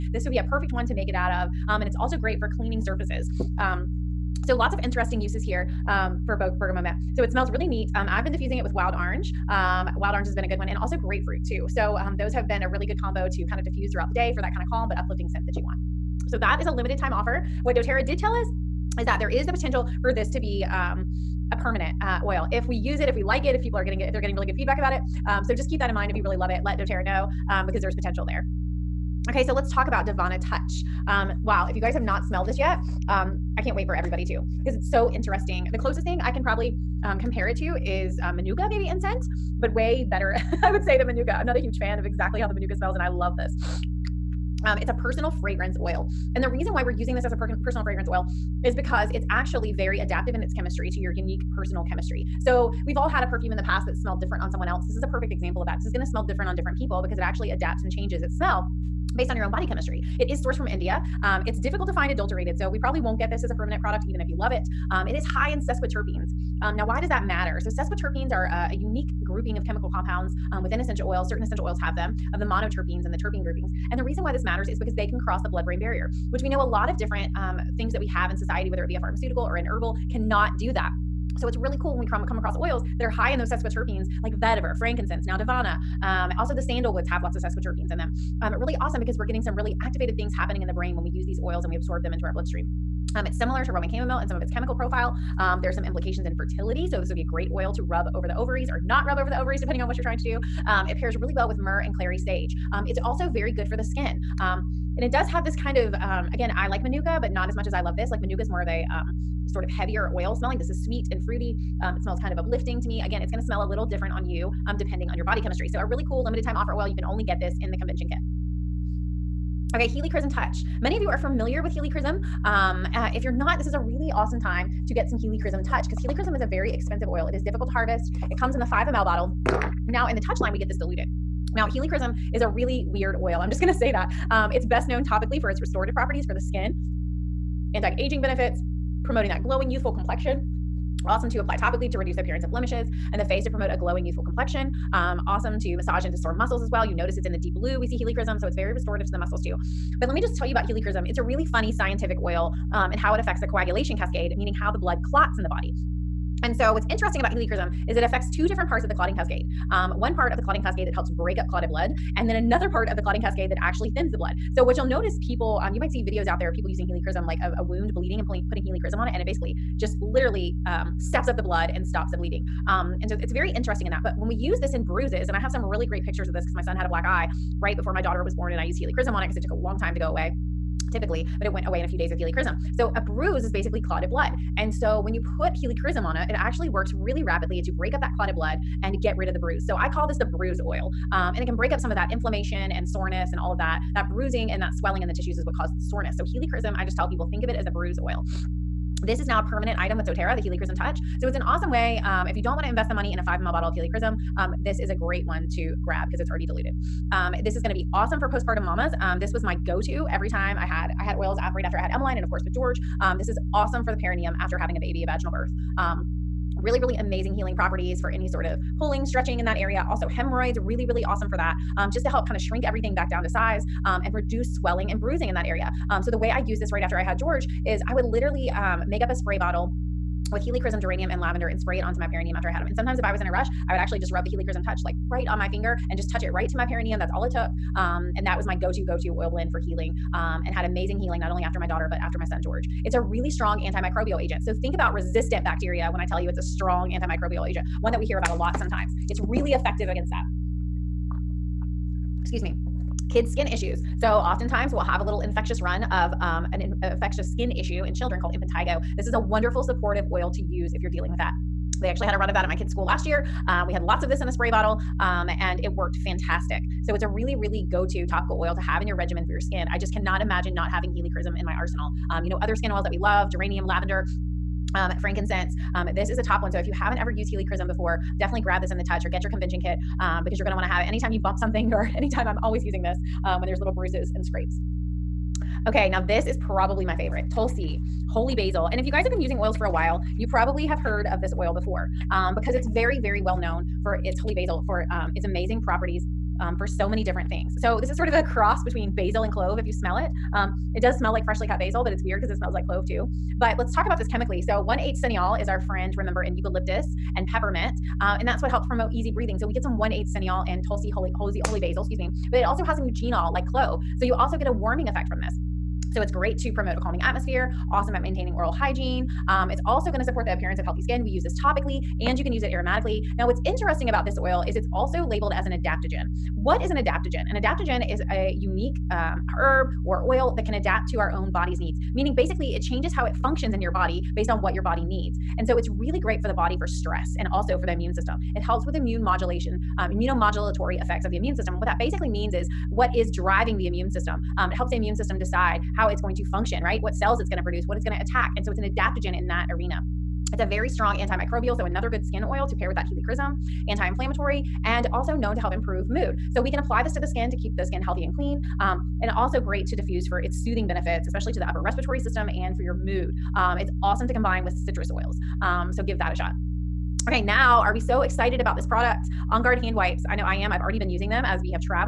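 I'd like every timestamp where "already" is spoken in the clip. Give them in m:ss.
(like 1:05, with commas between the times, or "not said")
3:26, 6:10.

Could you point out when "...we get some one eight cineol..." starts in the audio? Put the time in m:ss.
5:09.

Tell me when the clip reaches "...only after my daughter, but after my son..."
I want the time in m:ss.
4:01.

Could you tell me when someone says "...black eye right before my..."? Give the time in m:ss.
2:56.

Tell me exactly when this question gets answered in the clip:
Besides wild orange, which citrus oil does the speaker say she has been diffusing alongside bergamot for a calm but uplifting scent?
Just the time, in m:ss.
0:10.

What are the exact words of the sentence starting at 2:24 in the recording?
Um, awesome to massage into sore muscles as well.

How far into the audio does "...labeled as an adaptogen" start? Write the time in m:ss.
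5:25.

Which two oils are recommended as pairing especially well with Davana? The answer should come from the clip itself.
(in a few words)
Myrrh and clary sage.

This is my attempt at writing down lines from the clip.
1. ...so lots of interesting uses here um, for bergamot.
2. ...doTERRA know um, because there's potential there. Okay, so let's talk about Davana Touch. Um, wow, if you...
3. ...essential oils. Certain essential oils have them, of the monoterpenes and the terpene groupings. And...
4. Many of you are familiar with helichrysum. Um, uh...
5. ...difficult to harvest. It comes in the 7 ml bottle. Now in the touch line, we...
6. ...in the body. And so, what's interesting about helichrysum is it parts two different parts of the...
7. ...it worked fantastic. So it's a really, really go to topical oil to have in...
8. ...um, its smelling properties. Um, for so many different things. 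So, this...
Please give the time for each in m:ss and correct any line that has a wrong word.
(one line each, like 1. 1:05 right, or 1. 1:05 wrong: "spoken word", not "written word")
1. 0:04 right
2. 0:26 right
3. 1:10 right
4. 2:00 right
5. 2:07 wrong: "5", not "7"
6. 2:35 wrong: "affects", not "parts"
7. 4:25 right
8. 4:54 wrong: "amazing", not "smelling".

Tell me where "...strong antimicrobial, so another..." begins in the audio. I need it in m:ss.
5:50.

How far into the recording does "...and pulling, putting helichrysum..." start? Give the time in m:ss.
2:48.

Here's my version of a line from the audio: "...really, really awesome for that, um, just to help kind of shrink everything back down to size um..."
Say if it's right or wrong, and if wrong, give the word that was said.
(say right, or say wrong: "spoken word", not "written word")
right.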